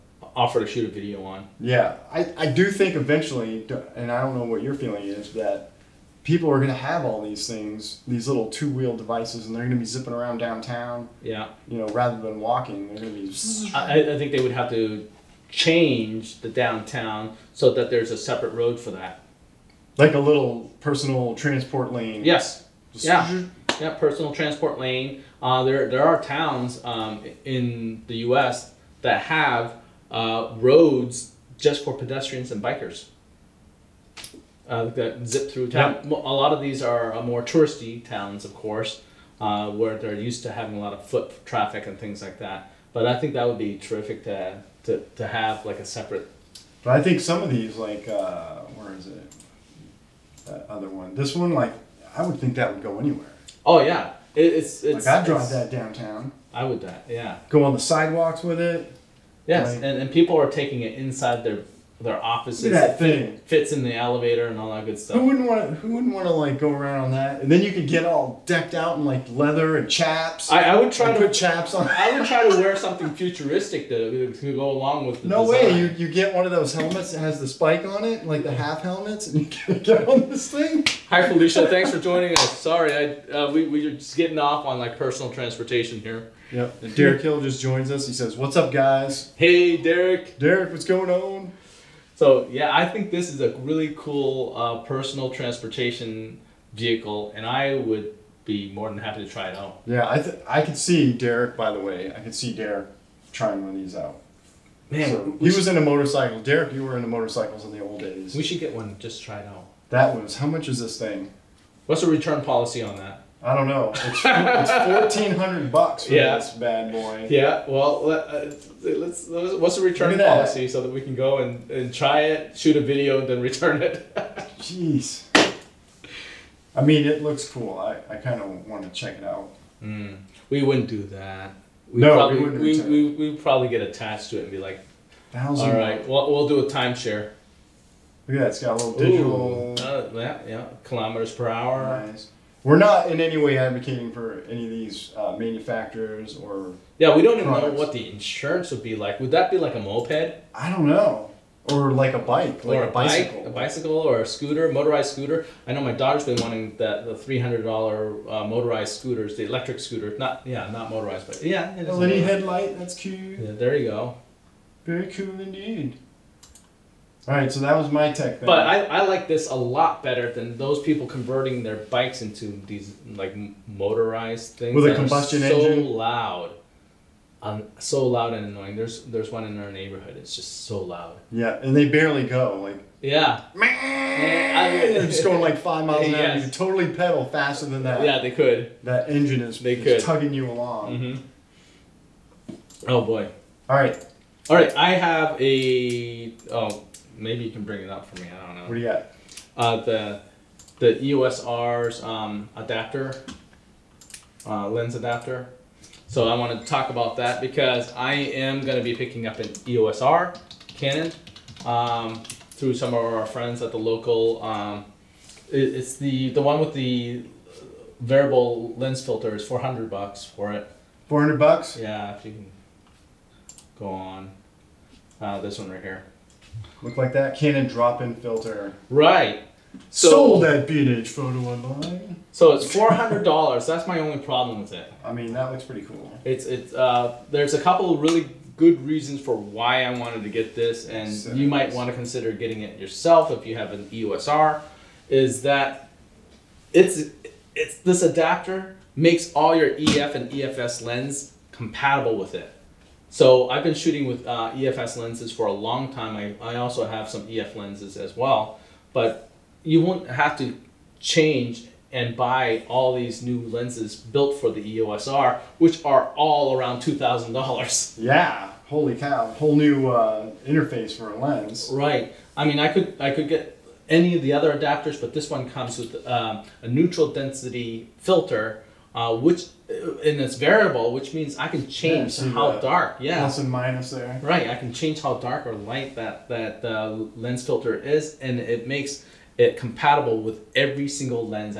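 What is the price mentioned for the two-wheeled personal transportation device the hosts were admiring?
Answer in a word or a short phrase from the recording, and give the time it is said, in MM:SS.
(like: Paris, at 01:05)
$1,400, at 01:54.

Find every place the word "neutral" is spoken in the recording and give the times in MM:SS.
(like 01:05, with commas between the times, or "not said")
04:36.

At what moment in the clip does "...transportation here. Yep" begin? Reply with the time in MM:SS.
01:25.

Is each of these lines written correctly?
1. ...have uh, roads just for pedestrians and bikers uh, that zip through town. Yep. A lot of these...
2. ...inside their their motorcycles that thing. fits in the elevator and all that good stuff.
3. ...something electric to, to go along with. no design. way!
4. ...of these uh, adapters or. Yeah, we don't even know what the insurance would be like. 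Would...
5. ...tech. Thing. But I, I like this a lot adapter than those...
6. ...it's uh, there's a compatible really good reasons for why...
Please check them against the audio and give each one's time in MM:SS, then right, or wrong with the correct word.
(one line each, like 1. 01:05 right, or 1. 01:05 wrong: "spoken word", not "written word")
1. 00:29 right
2. 01:00 wrong: "offices", not "motorcycles"
3. 01:12 wrong: "futuristic", not "electric"
4. 02:24 wrong: "manufacturers", not "adapters"
5. 02:48 wrong: "better", not "adapter"
6. 03:56 wrong: "couple", not "compatible".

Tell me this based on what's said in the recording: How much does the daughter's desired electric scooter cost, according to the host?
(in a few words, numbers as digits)
$300.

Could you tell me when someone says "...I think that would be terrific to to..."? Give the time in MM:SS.
00:43.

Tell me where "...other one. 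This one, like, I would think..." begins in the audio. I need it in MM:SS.
00:50.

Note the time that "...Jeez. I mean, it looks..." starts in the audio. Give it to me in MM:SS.
02:04.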